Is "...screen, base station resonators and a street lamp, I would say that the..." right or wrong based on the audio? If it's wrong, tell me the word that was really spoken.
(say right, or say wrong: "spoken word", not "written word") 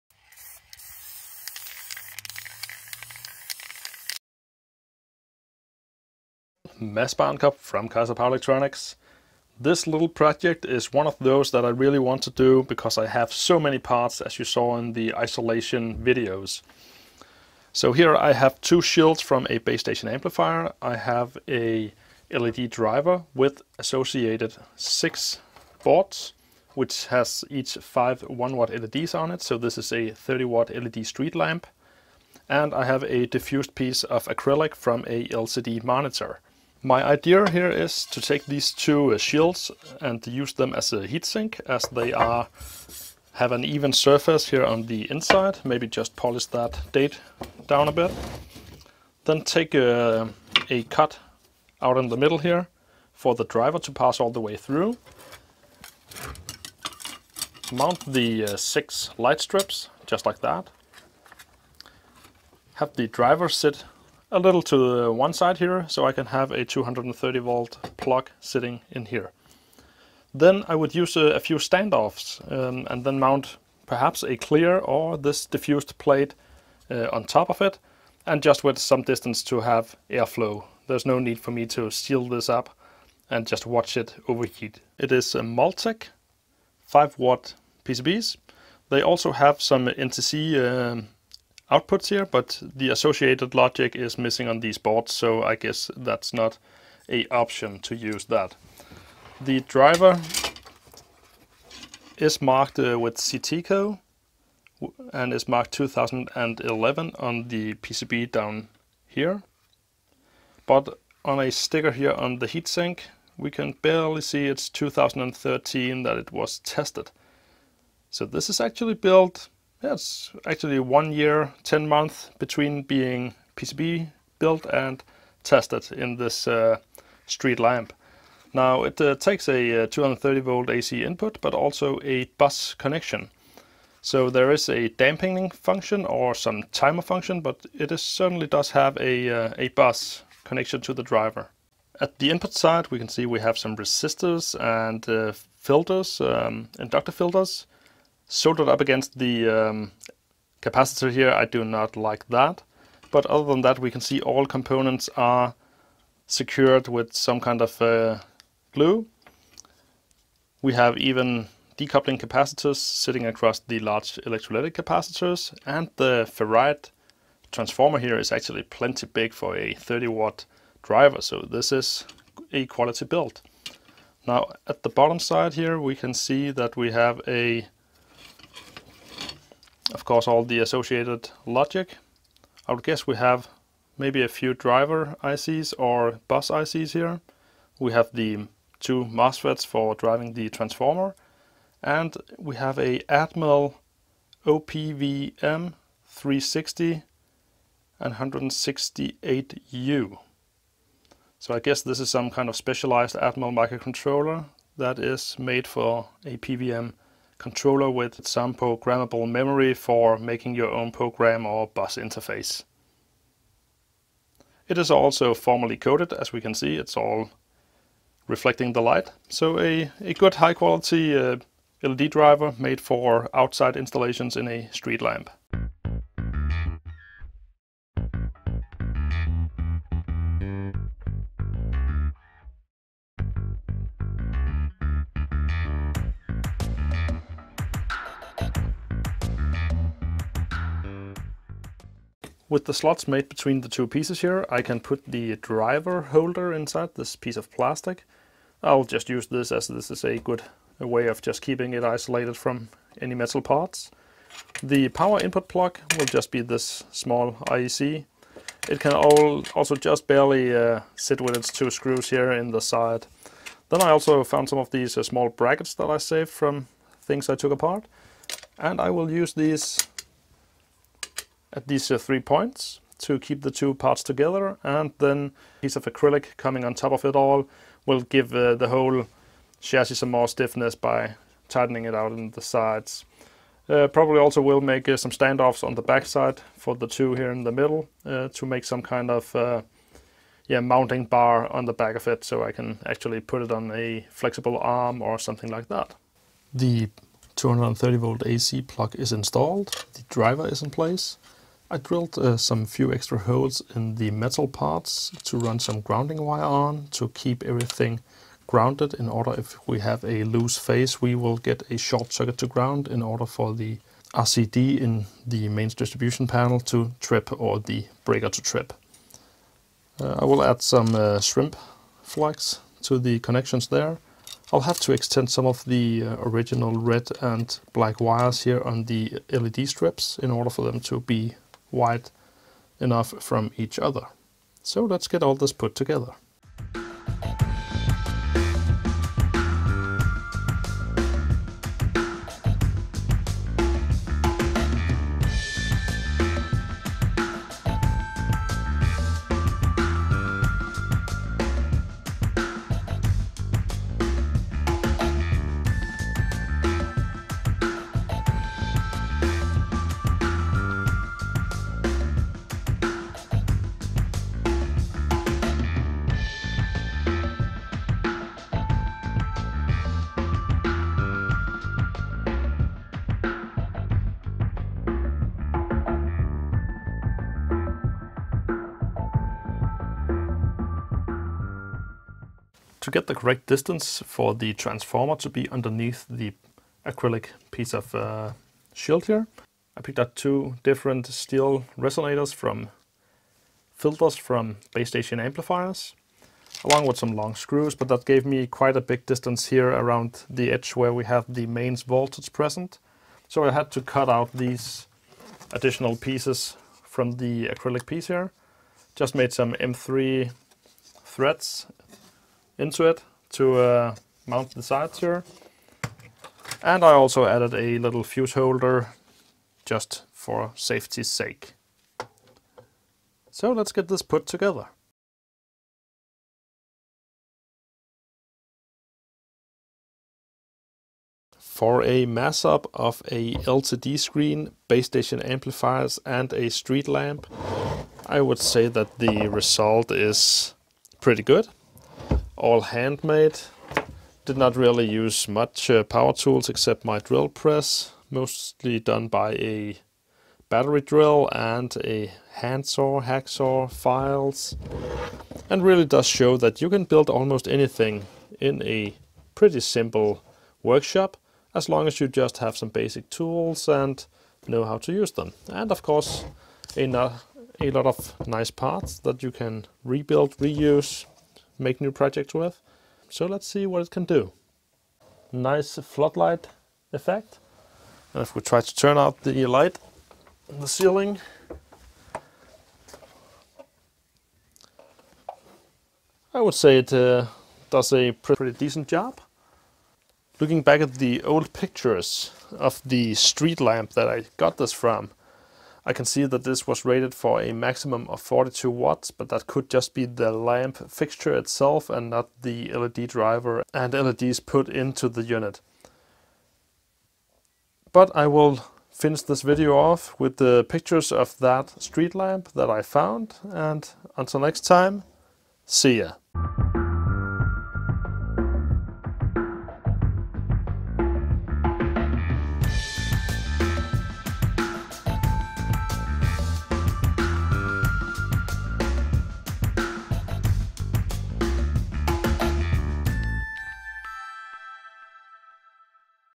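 wrong: "amplifiers", not "resonators".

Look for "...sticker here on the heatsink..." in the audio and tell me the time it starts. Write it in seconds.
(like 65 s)
111 s.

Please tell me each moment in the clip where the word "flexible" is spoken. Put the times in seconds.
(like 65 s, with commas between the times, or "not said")
294 s.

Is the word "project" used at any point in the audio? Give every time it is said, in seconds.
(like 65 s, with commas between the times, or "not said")
10 s, 471 s.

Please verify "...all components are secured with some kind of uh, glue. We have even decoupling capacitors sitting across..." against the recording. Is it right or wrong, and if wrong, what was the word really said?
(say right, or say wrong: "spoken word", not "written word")
right.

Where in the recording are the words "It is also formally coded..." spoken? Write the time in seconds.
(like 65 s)
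214 s.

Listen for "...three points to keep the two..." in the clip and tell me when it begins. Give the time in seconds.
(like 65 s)
271 s.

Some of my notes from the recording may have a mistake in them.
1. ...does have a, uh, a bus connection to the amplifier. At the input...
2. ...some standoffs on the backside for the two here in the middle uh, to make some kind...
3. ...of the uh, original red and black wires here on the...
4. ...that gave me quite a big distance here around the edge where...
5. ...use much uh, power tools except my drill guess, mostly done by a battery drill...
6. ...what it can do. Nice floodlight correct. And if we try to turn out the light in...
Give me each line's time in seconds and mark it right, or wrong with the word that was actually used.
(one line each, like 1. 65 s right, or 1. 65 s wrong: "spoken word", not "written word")
1. 138 s wrong: "driver", not "amplifier"
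2. 284 s right
3. 325 s right
4. 397 s right
5. 444 s wrong: "press", not "guess"
6. 473 s wrong: "effect", not "correct".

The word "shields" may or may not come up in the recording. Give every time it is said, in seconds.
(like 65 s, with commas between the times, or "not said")
18 s, 39 s, 388 s.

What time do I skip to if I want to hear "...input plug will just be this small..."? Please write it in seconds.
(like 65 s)
255 s.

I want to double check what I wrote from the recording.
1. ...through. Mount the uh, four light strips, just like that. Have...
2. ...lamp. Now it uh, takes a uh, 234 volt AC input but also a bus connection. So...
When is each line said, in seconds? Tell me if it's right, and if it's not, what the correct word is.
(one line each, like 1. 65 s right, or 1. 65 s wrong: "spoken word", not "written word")
1. 54 s wrong: "six", not "four"
2. 127 s wrong: "230", not "234".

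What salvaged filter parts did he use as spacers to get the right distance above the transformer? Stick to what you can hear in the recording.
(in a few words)
Steel resonators.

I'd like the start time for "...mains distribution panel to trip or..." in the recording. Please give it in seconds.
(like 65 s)
315 s.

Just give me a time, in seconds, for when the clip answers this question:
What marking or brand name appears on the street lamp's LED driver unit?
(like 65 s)
103 s.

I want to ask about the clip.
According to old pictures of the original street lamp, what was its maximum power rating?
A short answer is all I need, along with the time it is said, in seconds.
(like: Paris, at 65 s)
42 watts, at 498 s.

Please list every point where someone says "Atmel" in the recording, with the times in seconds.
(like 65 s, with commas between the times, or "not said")
193 s, 203 s.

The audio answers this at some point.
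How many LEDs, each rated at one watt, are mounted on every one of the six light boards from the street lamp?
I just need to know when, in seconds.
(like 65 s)
27 s.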